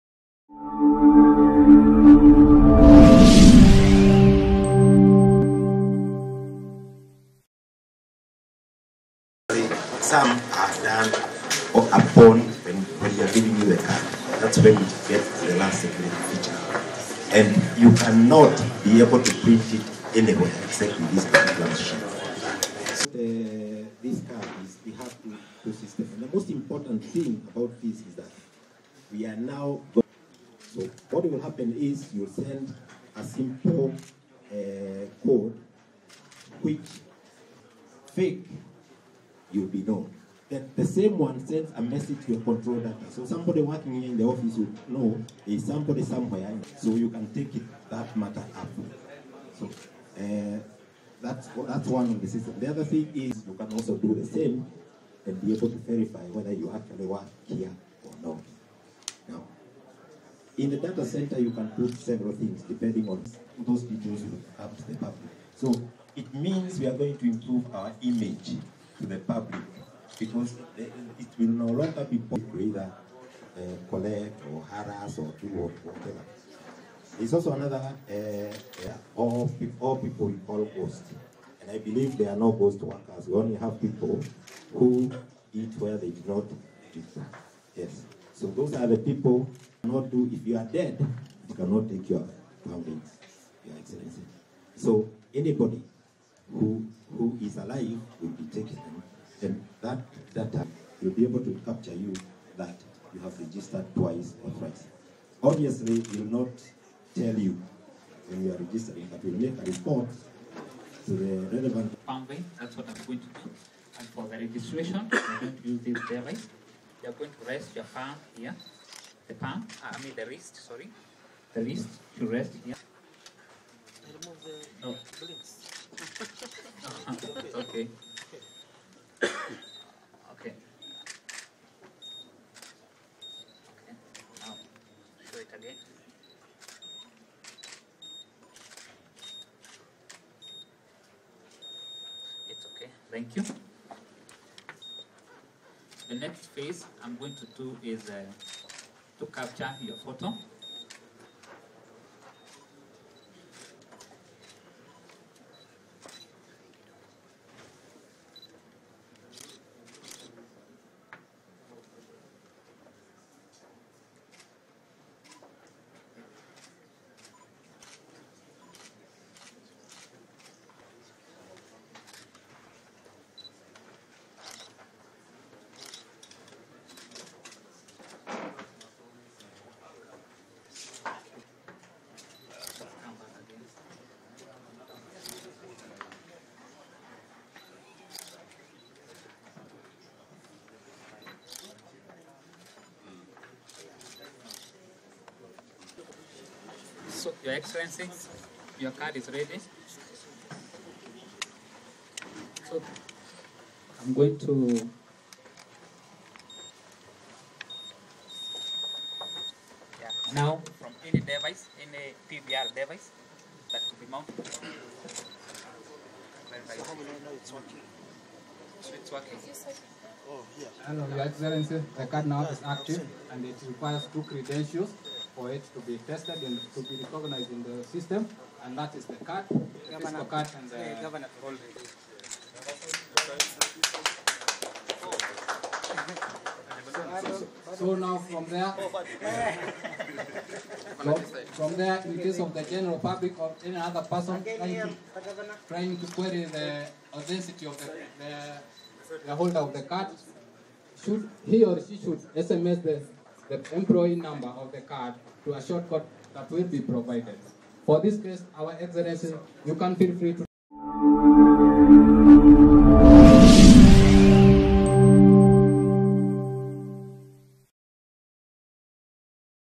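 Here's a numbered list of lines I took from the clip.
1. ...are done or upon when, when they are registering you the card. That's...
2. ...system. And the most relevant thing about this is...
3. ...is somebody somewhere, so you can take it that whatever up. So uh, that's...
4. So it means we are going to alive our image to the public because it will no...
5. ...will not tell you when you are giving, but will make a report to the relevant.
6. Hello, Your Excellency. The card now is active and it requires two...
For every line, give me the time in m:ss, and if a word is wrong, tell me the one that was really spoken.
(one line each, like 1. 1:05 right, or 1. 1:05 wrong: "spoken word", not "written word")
1. 0:10 wrong: "giving", not "registering"
2. 0:25 wrong: "important", not "relevant"
3. 0:45 wrong: "matter", not "whatever"
4. 1:05 wrong: "improve", not "alive"
5. 1:46 wrong: "registering", not "giving"
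6. 3:40 right.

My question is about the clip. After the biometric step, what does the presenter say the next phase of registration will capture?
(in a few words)
Photo.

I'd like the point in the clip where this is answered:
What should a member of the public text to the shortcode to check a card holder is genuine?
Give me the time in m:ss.
4:13.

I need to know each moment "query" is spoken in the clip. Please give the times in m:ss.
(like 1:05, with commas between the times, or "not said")
4:06.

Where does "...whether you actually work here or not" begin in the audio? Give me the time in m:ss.
0:56.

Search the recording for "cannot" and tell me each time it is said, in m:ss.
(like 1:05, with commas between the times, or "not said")
0:17, 1:31.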